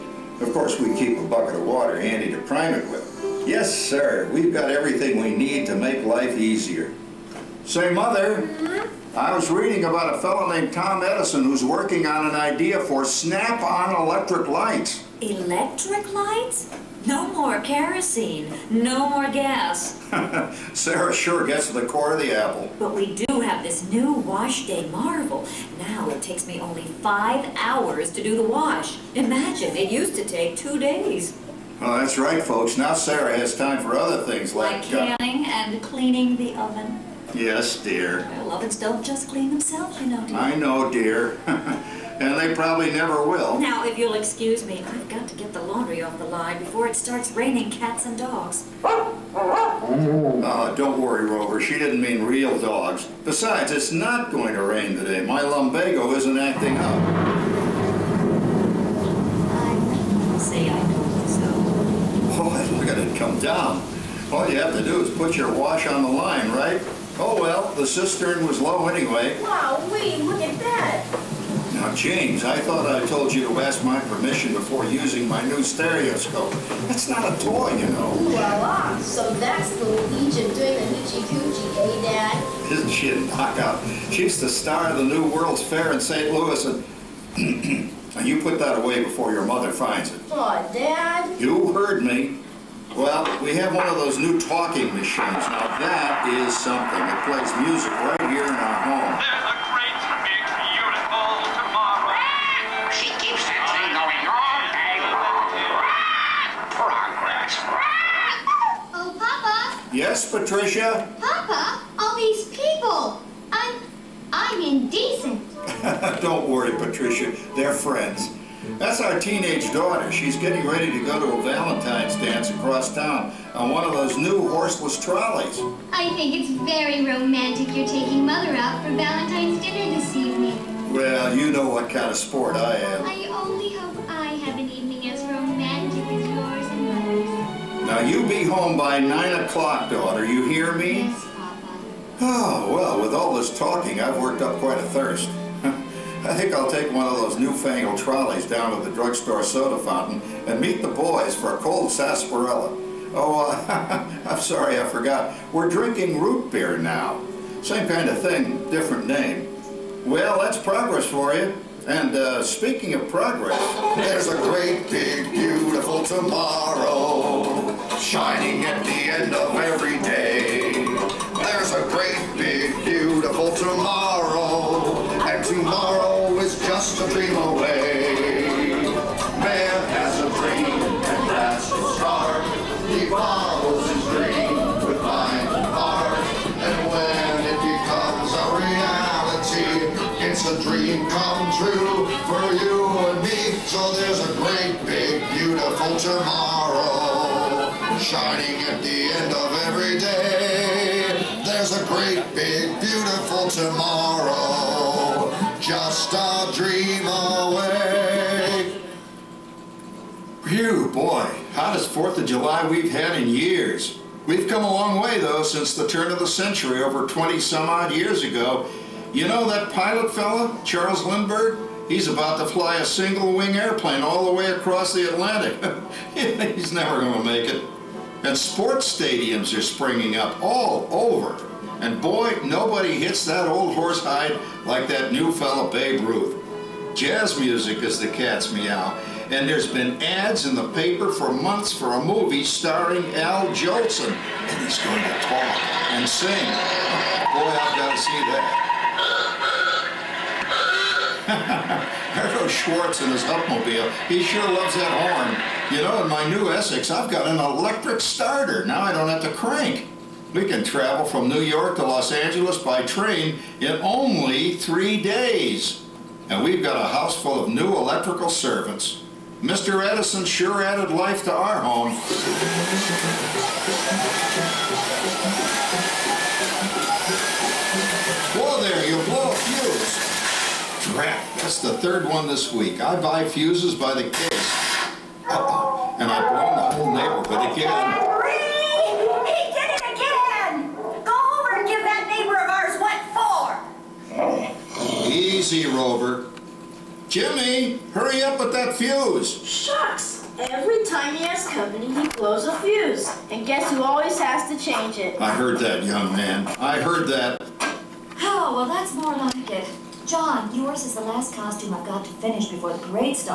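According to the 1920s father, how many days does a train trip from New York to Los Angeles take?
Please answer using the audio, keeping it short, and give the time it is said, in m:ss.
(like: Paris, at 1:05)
3 days, at 4:24.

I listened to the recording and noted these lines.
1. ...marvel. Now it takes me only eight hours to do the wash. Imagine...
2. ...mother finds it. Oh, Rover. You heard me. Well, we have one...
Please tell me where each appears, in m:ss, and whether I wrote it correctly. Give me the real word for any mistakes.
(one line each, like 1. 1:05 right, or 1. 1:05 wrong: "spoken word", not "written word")
1. 0:24 wrong: "five", not "eight"
2. 1:29 wrong: "Dad", not "Rover".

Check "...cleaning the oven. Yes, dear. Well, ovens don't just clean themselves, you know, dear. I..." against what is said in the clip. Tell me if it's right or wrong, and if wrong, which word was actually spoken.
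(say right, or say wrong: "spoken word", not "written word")
right.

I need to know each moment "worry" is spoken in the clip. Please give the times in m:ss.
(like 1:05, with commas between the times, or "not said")
0:50, 1:56.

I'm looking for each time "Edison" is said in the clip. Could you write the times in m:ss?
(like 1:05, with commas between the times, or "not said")
0:11, 4:29.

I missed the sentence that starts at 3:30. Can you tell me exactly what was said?
Phew, boy, hottest 4th of July we've had in years.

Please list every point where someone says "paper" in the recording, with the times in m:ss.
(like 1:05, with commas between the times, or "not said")
4:00.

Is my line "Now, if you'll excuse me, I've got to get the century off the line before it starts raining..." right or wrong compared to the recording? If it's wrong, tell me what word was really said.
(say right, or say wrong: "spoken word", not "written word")
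wrong: "laundry", not "century".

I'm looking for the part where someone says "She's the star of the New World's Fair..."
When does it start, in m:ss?
1:24.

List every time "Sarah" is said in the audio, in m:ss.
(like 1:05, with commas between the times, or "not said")
0:20, 0:32.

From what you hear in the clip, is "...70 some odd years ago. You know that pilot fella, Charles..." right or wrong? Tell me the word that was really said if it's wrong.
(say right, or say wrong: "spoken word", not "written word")
wrong: "20", not "70".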